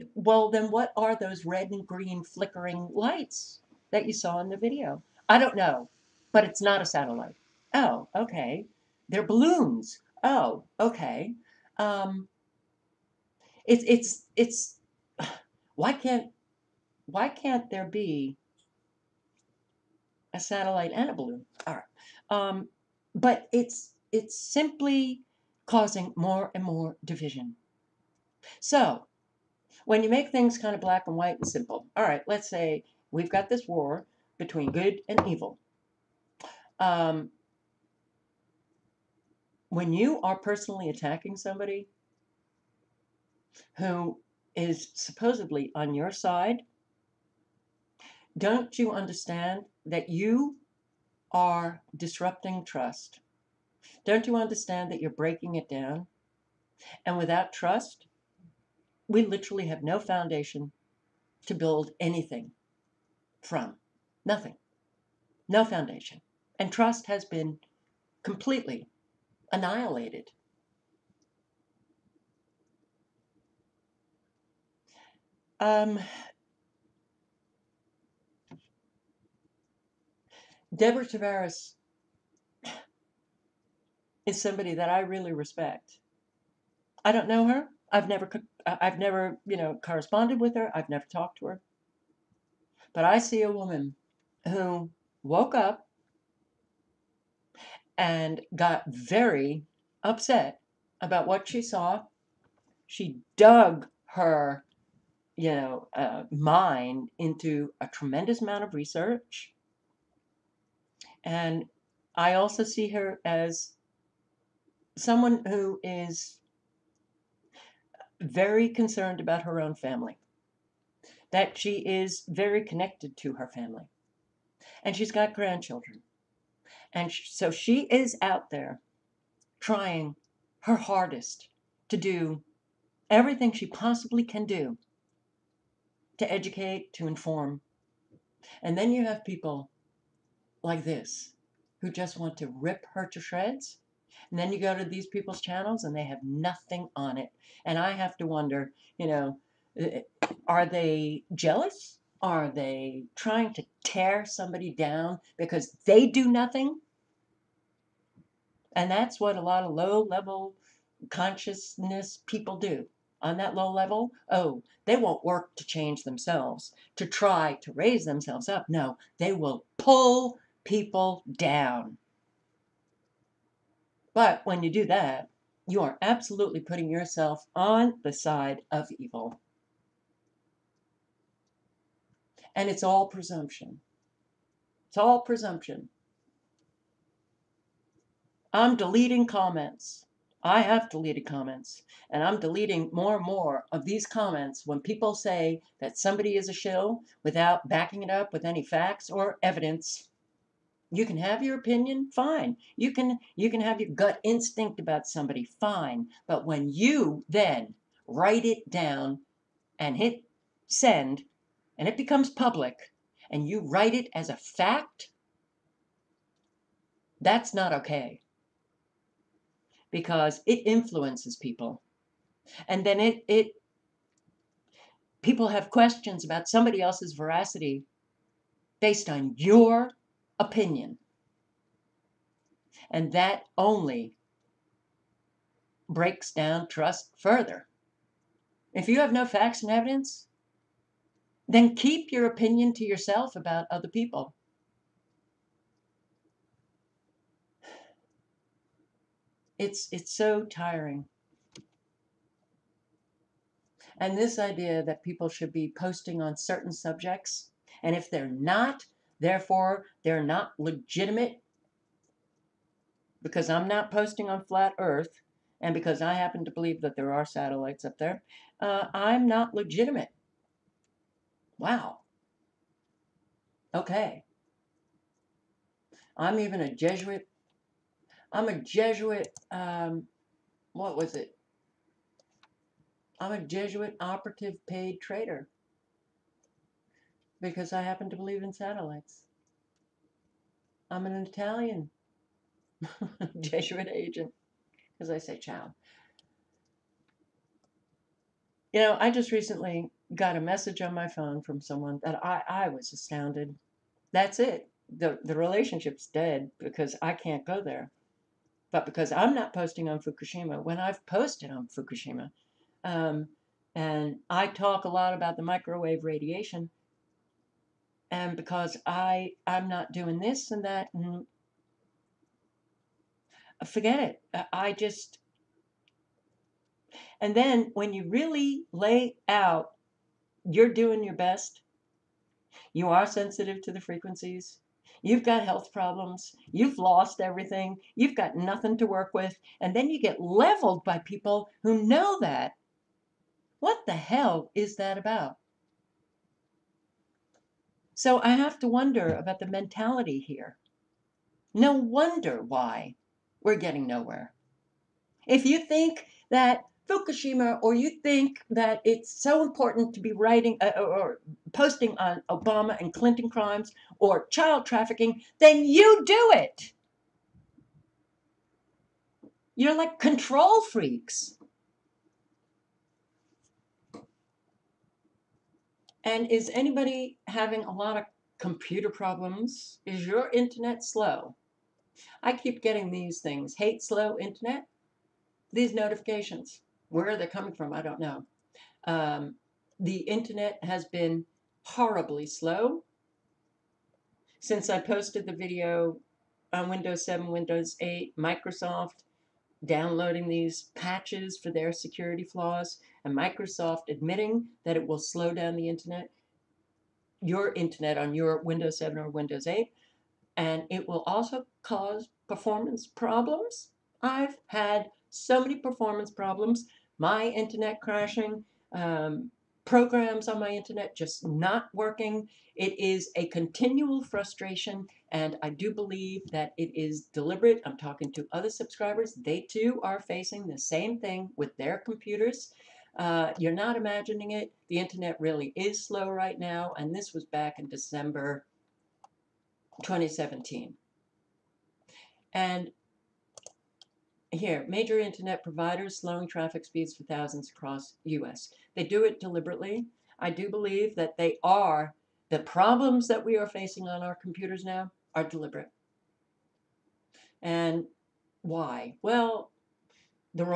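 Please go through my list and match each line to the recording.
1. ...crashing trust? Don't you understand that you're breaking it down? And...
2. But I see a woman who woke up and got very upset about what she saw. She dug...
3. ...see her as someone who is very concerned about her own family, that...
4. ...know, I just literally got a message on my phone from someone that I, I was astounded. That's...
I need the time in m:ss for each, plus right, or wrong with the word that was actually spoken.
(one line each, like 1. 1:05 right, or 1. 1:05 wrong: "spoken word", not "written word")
1. 0:51 wrong: "disrupting", not "crashing"
2. 1:32 right
3. 1:52 right
4. 4:58 wrong: "recently", not "literally".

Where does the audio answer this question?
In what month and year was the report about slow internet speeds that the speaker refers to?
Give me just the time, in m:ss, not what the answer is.
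7:17.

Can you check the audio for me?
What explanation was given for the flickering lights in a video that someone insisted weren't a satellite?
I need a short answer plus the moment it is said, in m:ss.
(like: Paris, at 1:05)
Balloons, at 0:09.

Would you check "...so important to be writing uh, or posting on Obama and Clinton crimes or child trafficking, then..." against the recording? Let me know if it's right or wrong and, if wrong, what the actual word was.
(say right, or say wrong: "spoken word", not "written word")
right.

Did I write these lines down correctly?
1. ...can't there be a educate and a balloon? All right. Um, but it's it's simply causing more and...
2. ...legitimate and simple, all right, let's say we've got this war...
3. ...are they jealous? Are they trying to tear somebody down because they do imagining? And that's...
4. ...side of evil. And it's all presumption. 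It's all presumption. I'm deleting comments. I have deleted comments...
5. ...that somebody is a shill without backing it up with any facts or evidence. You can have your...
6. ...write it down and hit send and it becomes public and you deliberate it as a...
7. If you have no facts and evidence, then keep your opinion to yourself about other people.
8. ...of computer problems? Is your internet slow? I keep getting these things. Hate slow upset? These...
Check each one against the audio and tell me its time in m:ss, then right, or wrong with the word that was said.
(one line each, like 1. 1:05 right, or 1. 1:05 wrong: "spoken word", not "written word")
1. 0:17 wrong: "satellite", not "educate"
2. 0:31 wrong: "white", not "legitimate"
3. 2:30 wrong: "nothing", not "imagining"
4. 2:58 right
5. 3:15 right
6. 3:28 wrong: "write", not "deliberate"
7. 3:58 right
8. 6:17 wrong: "internet", not "upset".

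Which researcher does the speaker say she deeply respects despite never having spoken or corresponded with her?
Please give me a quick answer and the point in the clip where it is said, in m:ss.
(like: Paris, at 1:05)
Deborah Tavares, at 1:20.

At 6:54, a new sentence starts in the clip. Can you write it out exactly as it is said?
I've had so many performance problems my internet crashing, um, programs on my internet just not working.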